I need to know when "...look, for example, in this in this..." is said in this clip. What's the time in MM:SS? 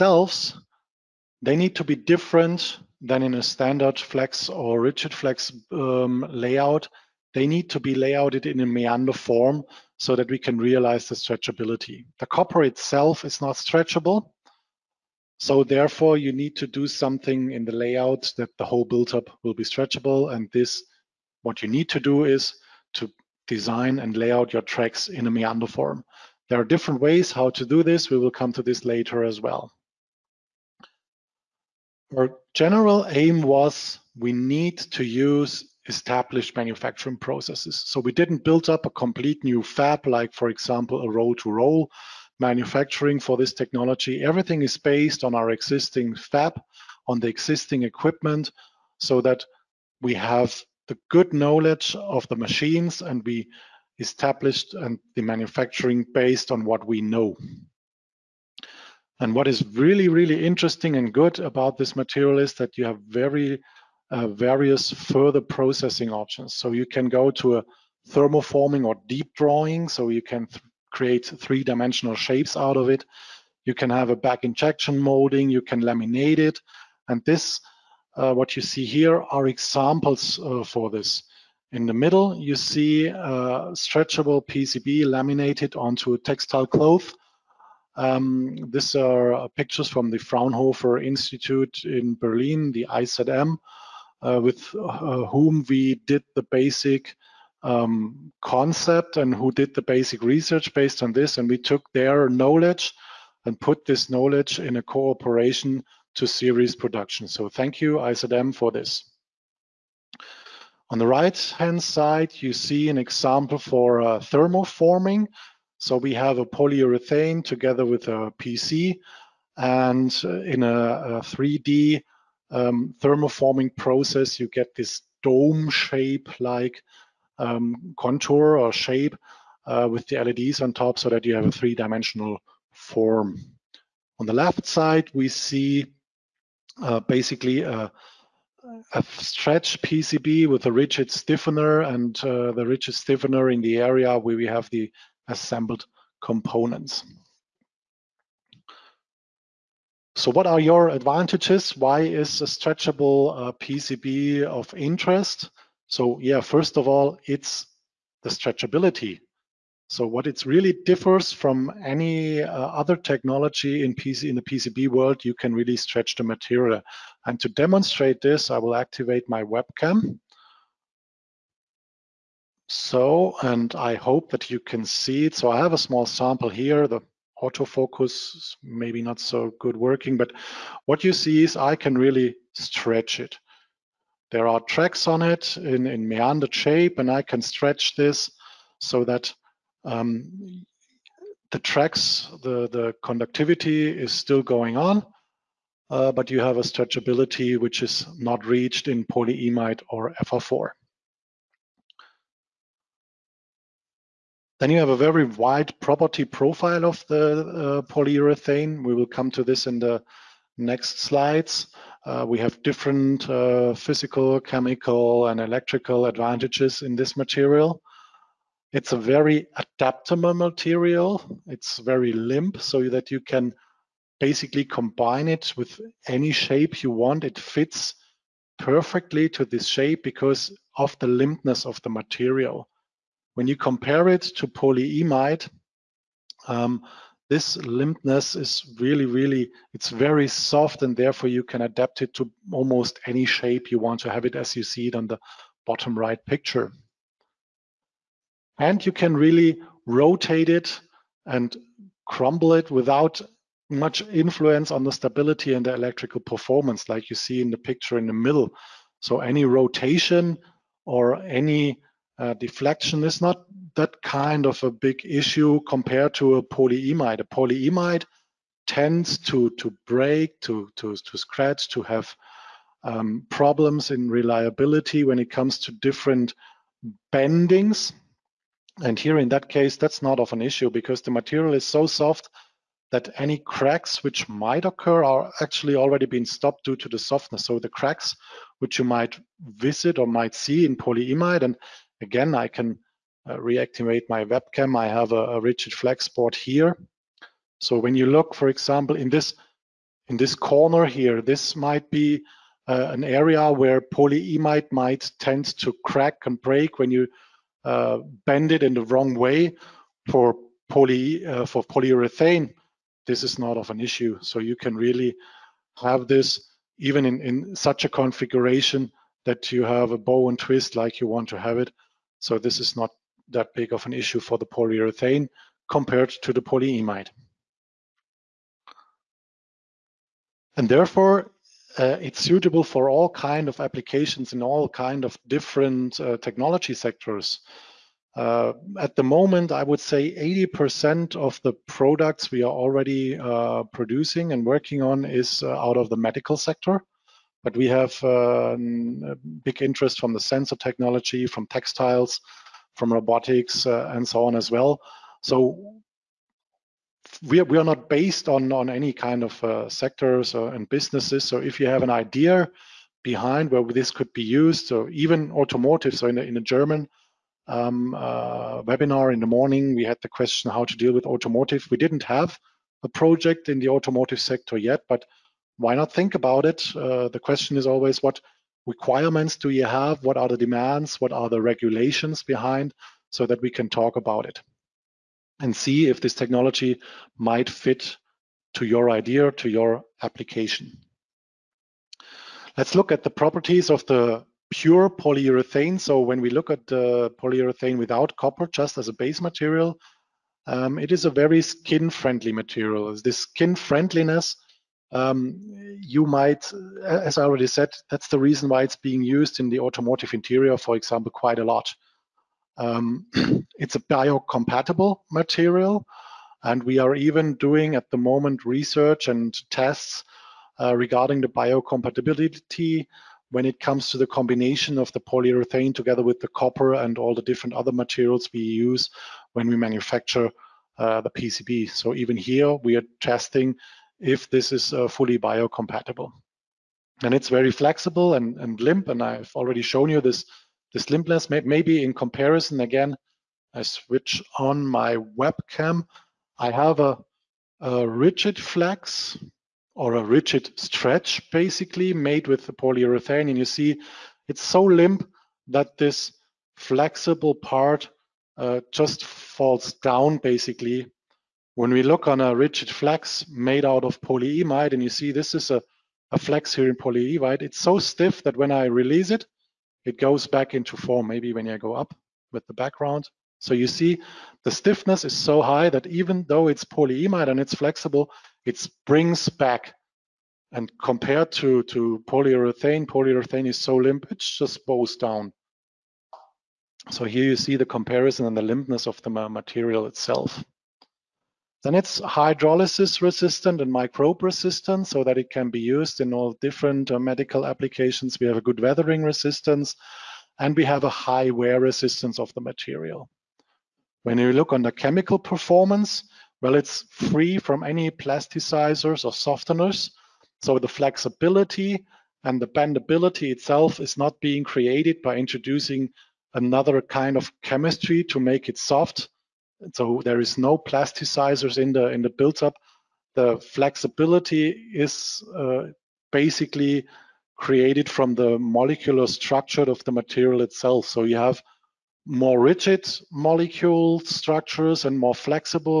04:58.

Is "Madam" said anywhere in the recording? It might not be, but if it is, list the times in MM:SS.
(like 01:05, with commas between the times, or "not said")
not said.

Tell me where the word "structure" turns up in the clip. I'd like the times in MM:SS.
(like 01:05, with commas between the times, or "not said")
08:49, 08:54.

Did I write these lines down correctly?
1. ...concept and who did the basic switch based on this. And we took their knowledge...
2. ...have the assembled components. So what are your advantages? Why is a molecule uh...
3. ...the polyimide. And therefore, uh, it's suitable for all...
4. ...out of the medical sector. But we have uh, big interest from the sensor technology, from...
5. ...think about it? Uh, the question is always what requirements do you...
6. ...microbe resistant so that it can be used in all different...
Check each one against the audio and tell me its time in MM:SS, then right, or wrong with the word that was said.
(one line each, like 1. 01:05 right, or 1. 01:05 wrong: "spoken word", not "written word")
1. 01:38 wrong: "research", not "switch"
2. 02:24 wrong: "stretchable", not "molecule"
3. 05:26 right
4. 05:45 right
5. 06:15 right
6. 08:13 right.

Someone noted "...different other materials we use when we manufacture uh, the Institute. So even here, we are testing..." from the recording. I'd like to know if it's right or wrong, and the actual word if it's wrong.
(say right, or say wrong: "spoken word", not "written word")
wrong: "PCB", not "Institute".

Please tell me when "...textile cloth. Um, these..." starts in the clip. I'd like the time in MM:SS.
01:26.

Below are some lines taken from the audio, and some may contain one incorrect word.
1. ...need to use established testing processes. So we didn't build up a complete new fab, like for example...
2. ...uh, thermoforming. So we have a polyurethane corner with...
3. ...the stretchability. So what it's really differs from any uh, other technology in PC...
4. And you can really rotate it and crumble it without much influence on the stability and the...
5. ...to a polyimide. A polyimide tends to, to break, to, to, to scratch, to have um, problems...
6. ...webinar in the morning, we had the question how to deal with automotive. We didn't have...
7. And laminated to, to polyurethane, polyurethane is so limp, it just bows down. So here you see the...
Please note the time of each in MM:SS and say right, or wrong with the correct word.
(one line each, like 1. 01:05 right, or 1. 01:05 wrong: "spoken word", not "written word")
1. 00:34 wrong: "manufacturing", not "testing"
2. 01:54 wrong: "together", not "corner"
3. 02:38 right
4. 04:08 right
5. 04:26 right
6. 06:08 right
7. 08:00 wrong: "compared", not "laminated".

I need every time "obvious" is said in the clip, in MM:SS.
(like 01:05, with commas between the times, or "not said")
not said.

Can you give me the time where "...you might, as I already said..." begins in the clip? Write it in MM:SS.
06:45.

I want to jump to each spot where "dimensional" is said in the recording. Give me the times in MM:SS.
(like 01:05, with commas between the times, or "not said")
01:11, 02:11.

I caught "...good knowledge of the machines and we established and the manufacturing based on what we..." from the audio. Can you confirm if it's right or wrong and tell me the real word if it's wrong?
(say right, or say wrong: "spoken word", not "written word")
right.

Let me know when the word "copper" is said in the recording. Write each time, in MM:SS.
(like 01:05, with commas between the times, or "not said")
00:12, 06:38, 07:06.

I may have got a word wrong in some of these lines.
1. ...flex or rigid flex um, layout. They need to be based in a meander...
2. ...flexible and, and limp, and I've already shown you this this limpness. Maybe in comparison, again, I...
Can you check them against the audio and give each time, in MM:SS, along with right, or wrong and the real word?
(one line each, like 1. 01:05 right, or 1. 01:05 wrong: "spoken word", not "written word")
1. 00:03 wrong: "layouted", not "based"
2. 07:17 right.